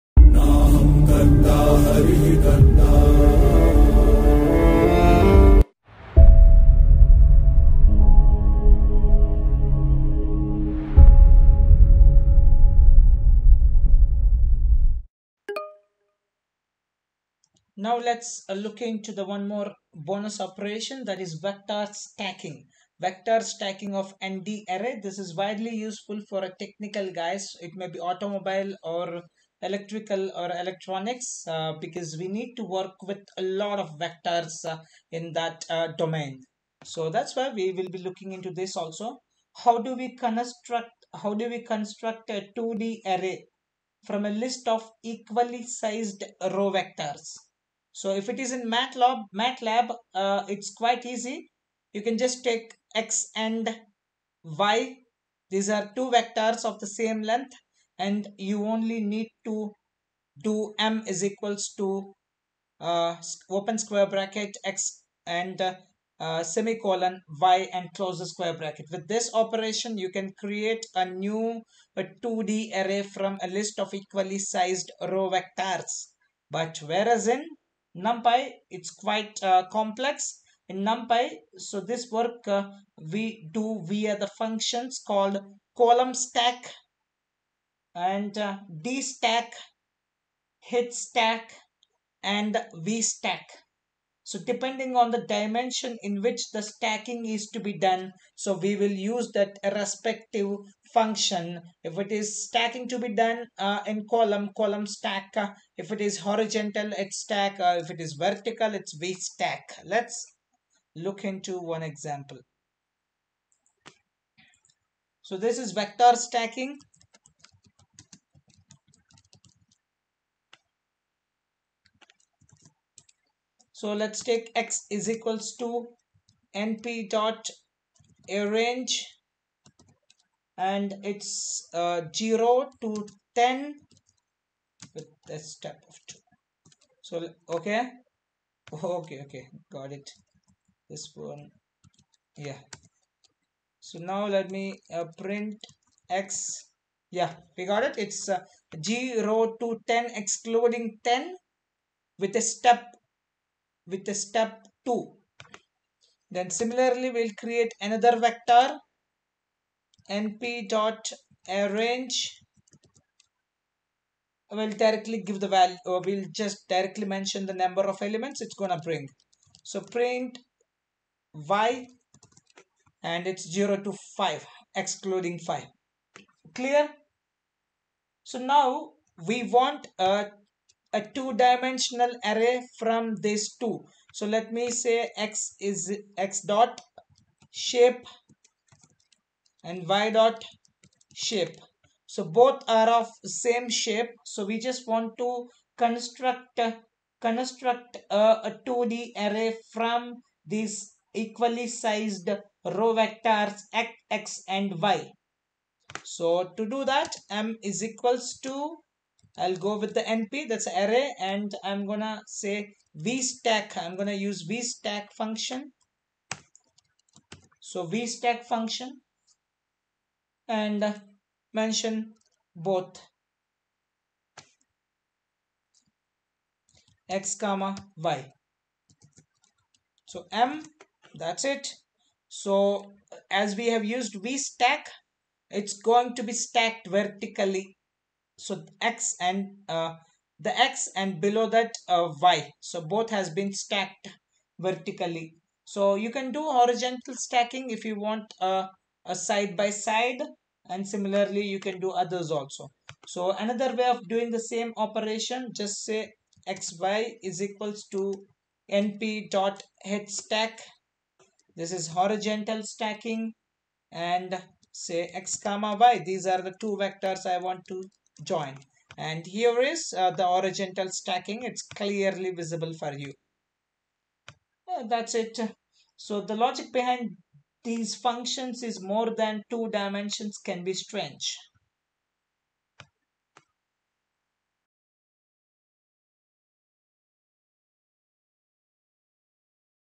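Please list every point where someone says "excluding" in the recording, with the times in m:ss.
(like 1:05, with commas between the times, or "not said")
2:30, 2:54.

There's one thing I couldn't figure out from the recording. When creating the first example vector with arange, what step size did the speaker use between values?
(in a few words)
2.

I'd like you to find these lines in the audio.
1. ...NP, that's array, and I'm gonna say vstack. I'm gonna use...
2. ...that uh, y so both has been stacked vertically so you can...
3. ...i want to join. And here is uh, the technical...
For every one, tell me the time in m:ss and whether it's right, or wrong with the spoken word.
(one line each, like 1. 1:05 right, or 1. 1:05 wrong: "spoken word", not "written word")
1. 3:30 right
2. 4:01 right
3. 4:27 wrong: "horizontal", not "technical".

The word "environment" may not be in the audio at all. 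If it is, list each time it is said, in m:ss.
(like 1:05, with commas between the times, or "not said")
not said.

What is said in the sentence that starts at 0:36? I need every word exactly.
So that's why we will be looking into this also.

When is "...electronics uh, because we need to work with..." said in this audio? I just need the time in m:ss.
0:30.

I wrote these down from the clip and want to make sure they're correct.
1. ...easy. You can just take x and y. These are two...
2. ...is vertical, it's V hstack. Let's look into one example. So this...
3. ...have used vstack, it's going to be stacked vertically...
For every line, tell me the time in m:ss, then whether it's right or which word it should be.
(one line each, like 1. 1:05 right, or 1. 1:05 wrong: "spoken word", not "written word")
1. 0:51 right
2. 1:47 wrong: "stack", not "hstack"
3. 3:53 right.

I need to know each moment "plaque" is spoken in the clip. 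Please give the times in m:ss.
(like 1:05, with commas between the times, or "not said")
not said.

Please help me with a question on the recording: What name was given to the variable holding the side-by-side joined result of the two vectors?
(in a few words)
xy.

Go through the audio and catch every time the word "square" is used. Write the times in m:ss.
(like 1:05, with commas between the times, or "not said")
1:03, 1:08.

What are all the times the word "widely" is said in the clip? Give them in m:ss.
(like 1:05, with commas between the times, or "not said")
0:25.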